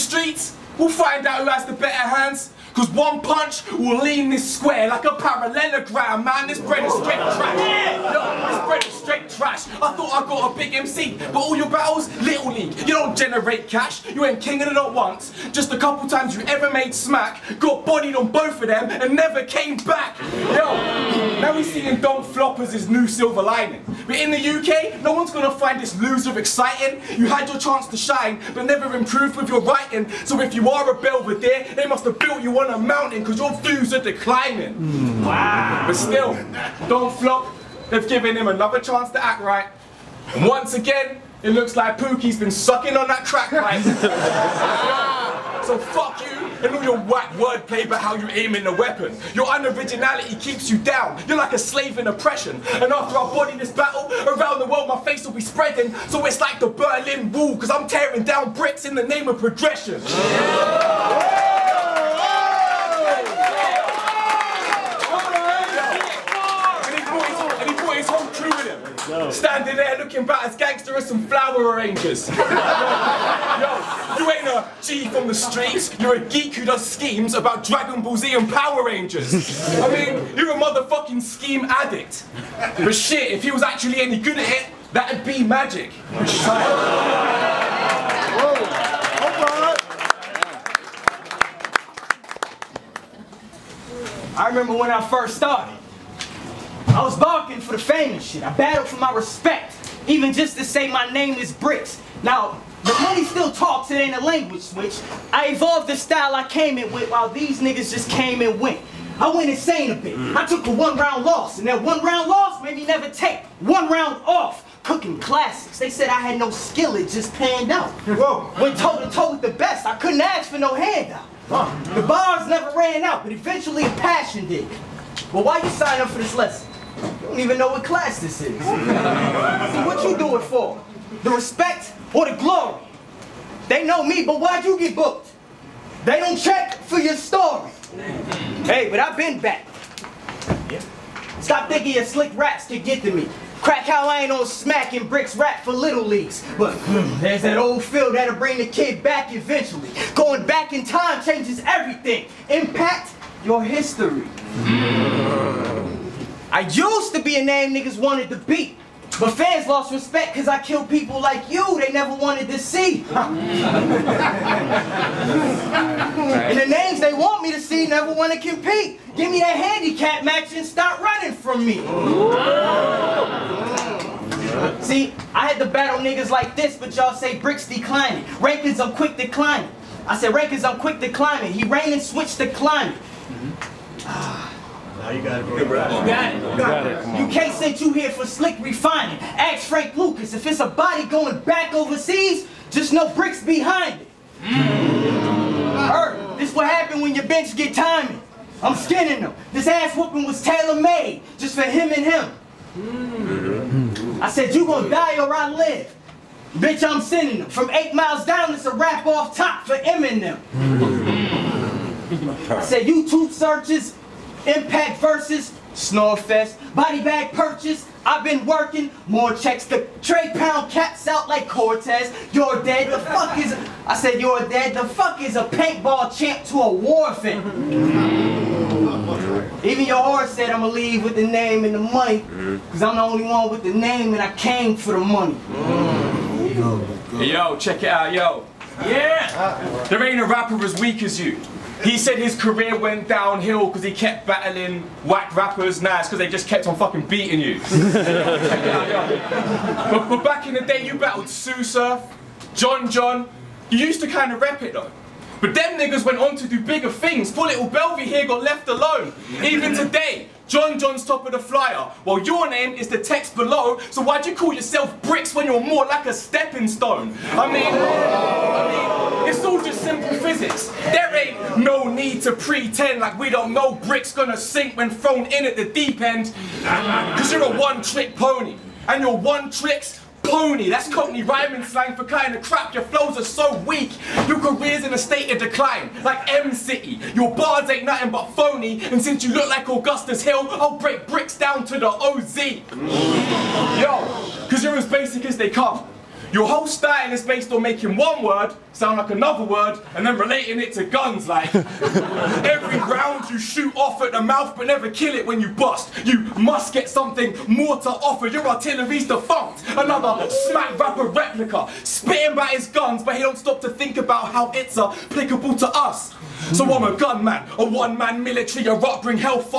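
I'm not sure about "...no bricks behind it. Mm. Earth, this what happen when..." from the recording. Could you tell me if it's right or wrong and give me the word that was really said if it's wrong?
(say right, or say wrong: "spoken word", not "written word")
right.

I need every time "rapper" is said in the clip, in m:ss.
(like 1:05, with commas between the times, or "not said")
4:00, 4:05, 5:10.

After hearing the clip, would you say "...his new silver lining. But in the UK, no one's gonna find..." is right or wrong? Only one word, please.
right.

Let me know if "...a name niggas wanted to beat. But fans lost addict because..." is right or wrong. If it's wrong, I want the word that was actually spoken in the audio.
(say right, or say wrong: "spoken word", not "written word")
wrong: "respect", not "addict".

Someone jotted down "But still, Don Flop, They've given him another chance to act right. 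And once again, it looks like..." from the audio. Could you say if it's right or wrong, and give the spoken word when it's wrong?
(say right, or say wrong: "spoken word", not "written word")
right.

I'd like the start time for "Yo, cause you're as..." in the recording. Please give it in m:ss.
4:53.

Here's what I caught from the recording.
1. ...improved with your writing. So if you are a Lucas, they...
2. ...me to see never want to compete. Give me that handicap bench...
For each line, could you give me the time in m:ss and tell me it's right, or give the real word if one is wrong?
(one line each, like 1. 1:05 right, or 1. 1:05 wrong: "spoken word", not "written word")
1. 0:28 wrong: "Belvedere", not "Lucas"
2. 2:47 wrong: "match", not "bench".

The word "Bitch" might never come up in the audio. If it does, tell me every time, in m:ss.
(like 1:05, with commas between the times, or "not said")
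3:26.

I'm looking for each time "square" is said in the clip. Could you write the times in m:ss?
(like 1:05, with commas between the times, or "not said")
0:04.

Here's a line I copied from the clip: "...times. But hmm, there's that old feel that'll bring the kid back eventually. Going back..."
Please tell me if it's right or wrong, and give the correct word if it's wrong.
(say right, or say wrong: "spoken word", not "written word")
wrong: "leagues", not "times".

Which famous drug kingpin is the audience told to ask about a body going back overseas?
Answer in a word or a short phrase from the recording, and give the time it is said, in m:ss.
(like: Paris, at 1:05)
Frank Lucas, at 3:09.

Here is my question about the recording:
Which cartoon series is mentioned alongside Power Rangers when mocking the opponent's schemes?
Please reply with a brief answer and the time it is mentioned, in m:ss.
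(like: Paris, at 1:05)
Dragon Ball Z, at 1:17.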